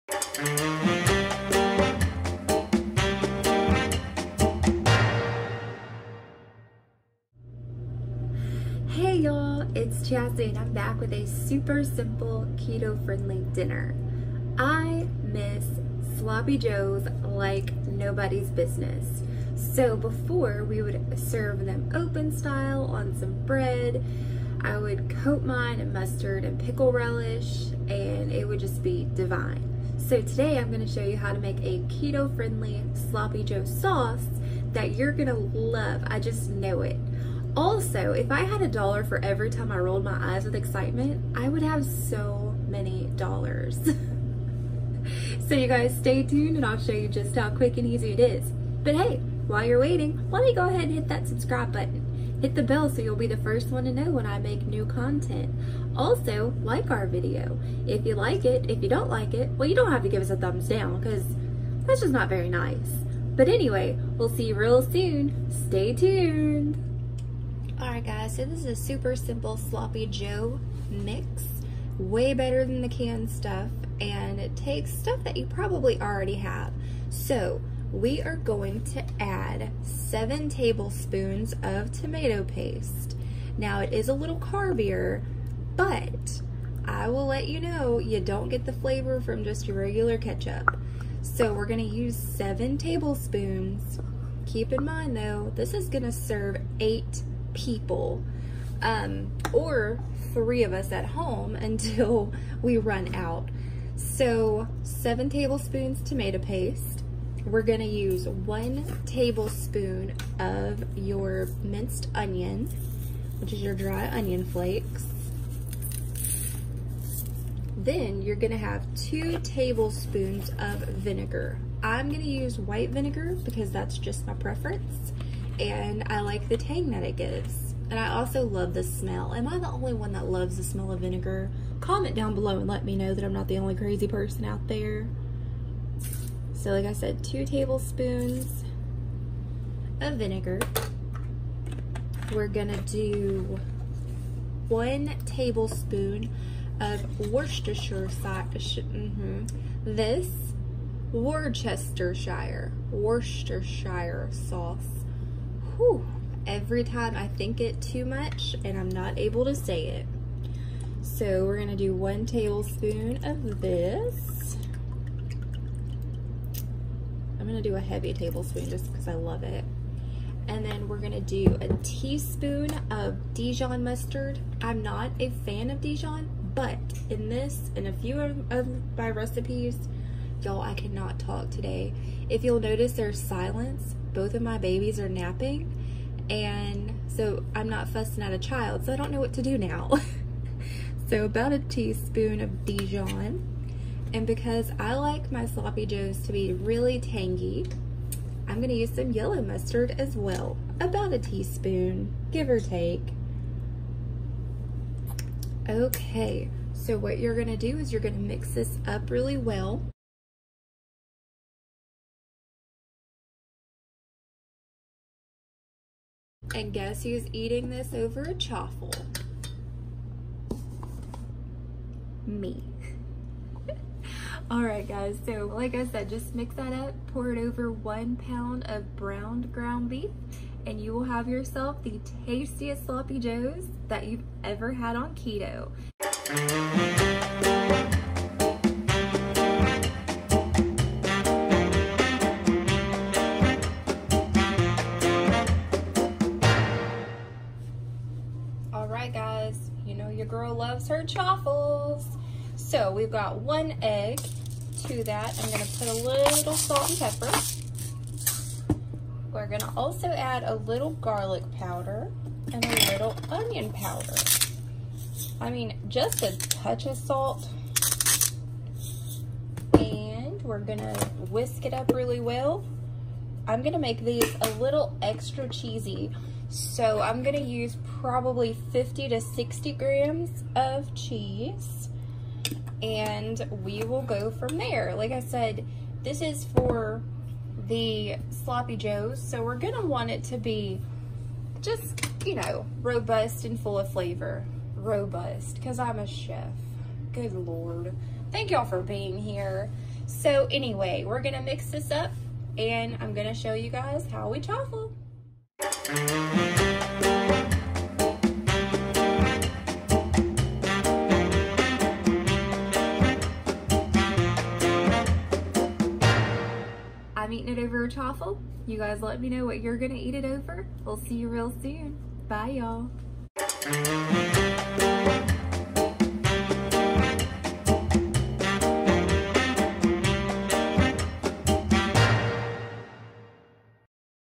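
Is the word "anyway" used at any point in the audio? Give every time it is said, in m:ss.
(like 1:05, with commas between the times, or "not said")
1:03, 5:00.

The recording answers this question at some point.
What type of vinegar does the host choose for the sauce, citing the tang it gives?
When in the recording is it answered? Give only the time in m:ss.
2:02.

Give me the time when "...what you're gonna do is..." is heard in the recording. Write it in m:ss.
3:26.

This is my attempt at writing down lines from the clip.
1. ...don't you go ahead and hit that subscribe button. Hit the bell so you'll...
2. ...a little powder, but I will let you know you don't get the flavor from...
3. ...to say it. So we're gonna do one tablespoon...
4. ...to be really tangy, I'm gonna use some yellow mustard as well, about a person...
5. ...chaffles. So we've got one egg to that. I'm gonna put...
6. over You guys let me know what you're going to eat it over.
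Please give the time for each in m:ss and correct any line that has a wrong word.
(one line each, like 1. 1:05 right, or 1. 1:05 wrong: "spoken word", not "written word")
1. 0:50 right
2. 1:24 wrong: "carbier", not "powder"
3. 2:39 right
4. 3:16 wrong: "teaspoon", not "person"
5. 4:11 right
6. 5:17 right.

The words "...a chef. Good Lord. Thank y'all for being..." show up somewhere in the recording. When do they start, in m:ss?
4:55.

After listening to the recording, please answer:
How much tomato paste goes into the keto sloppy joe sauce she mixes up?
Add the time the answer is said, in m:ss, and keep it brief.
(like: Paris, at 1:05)
7 tablespoons, at 1:19.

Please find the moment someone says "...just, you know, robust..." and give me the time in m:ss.
4:51.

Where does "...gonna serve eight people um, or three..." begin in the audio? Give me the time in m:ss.
1:35.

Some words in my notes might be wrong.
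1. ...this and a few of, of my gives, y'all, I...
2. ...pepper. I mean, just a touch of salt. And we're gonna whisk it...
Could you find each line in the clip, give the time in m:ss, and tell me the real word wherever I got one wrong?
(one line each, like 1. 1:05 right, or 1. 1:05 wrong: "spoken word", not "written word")
1. 2:57 wrong: "recipes", not "gives"
2. 4:23 wrong: "powder", not "pepper".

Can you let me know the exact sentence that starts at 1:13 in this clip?
And it takes stuff that you probably already have.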